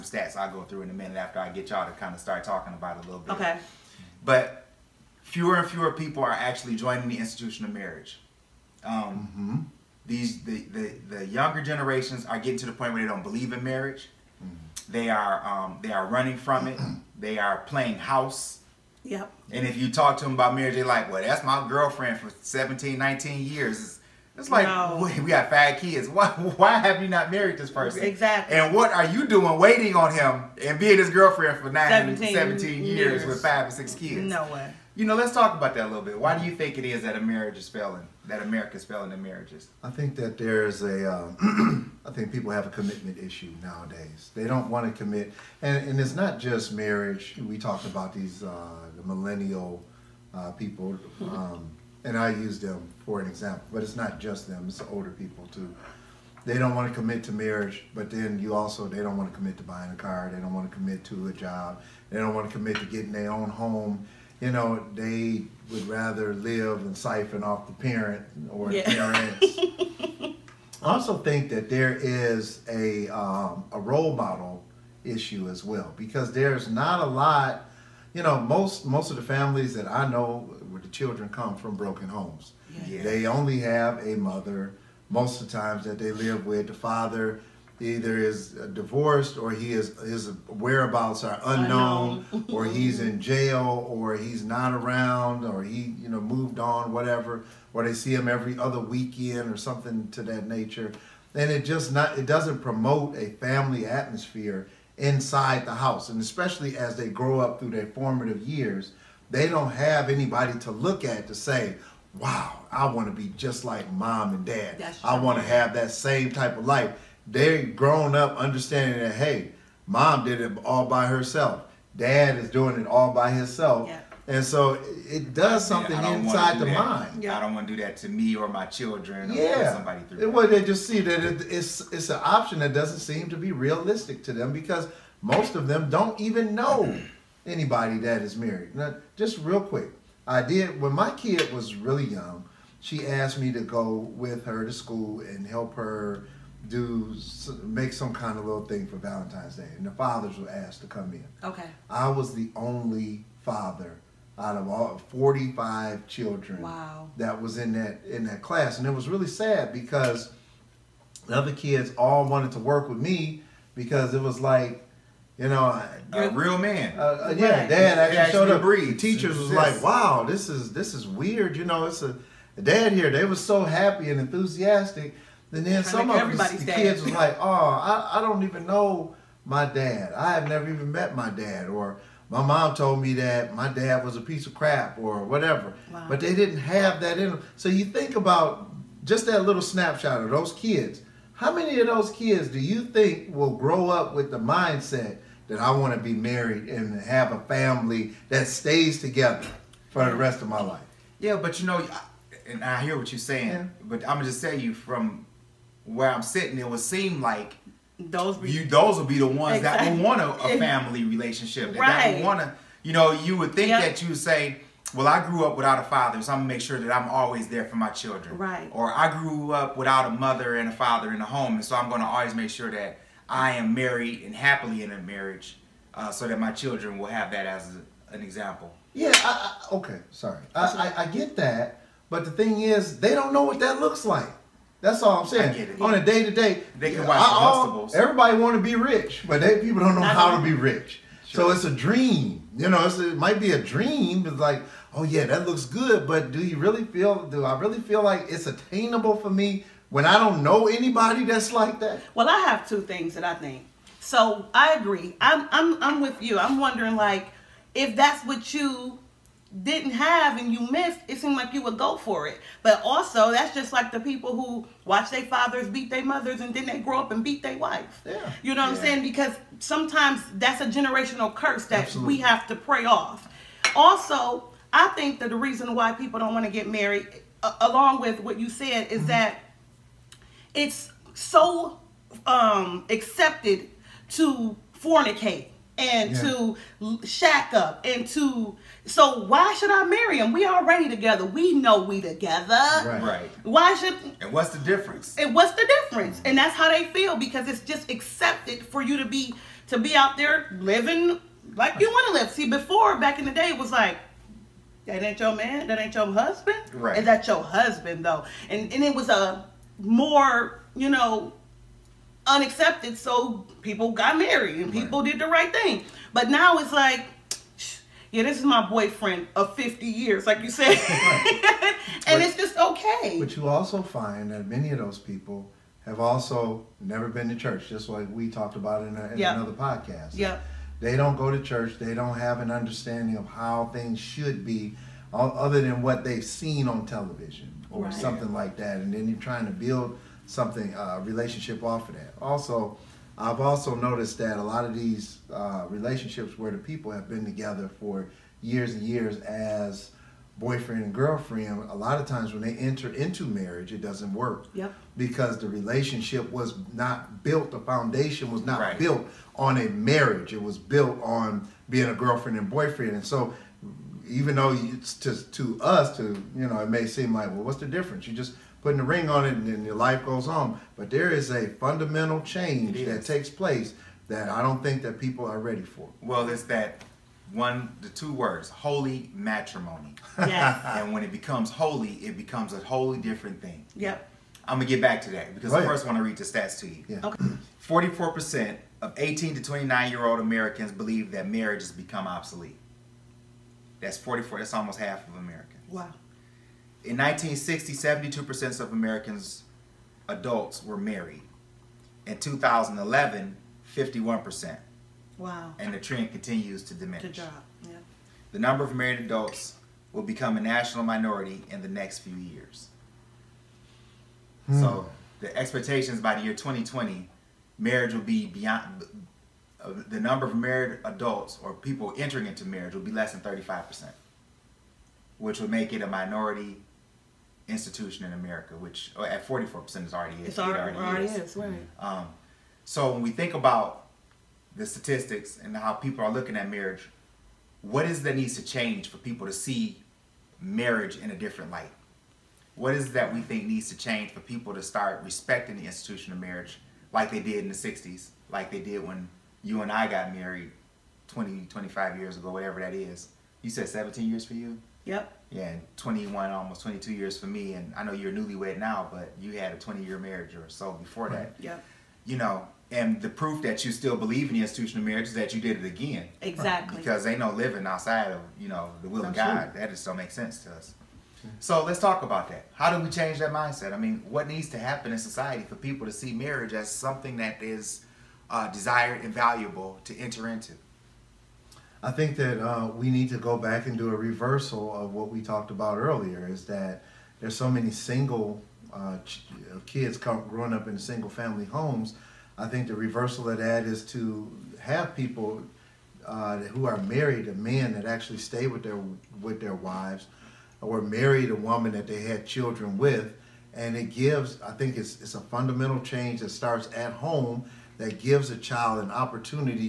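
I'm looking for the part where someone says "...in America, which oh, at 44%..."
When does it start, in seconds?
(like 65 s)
428 s.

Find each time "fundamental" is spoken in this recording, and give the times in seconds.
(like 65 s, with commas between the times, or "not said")
371 s, 505 s.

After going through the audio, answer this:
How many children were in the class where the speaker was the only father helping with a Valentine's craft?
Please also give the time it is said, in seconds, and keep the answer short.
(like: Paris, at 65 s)
45, at 154 s.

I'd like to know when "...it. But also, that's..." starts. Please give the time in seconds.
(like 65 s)
262 s.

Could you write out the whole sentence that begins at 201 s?
Yeah, but you know, and I hear what you're saying, yeah.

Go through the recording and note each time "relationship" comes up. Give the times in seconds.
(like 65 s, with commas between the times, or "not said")
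211 s, 340 s, 345 s, 355 s.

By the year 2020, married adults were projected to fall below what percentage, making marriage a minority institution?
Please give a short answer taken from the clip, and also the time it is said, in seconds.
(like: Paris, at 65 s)
35%, at 423 s.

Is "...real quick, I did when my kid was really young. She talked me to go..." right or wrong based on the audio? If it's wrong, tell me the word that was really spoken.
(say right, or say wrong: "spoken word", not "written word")
wrong: "asked", not "talked".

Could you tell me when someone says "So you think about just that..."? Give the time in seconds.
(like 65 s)
187 s.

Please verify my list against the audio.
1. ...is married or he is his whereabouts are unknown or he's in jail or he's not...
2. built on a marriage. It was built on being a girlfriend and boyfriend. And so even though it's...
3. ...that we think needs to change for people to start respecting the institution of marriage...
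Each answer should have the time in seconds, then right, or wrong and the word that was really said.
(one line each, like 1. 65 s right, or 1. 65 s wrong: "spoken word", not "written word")
1. 88 s wrong: "divorced", not "married"
2. 358 s right
3. 442 s right.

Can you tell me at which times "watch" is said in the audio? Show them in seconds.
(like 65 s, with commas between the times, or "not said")
237 s, 264 s.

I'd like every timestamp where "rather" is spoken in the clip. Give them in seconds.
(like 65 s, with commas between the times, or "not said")
65 s.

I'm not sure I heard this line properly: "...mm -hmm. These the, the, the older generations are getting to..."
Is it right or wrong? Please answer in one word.
wrong.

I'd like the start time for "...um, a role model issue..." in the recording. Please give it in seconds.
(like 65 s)
73 s.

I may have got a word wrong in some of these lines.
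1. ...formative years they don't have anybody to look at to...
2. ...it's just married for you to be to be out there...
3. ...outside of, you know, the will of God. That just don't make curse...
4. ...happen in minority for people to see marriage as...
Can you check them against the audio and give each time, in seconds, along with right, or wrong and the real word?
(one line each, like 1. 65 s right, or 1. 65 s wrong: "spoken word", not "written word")
1. 107 s right
2. 297 s wrong: "accepted", not "married"
3. 467 s wrong: "sense", not "curse"
4. 474 s wrong: "society", not "minority".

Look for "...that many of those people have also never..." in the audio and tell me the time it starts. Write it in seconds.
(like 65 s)
324 s.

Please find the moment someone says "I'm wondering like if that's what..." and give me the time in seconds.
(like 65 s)
256 s.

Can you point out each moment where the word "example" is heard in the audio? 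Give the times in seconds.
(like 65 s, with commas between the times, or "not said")
53 s, 228 s.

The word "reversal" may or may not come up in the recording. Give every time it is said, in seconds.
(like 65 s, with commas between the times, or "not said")
483 s, 492 s.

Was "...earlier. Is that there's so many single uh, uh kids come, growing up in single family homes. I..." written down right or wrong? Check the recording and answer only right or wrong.
right.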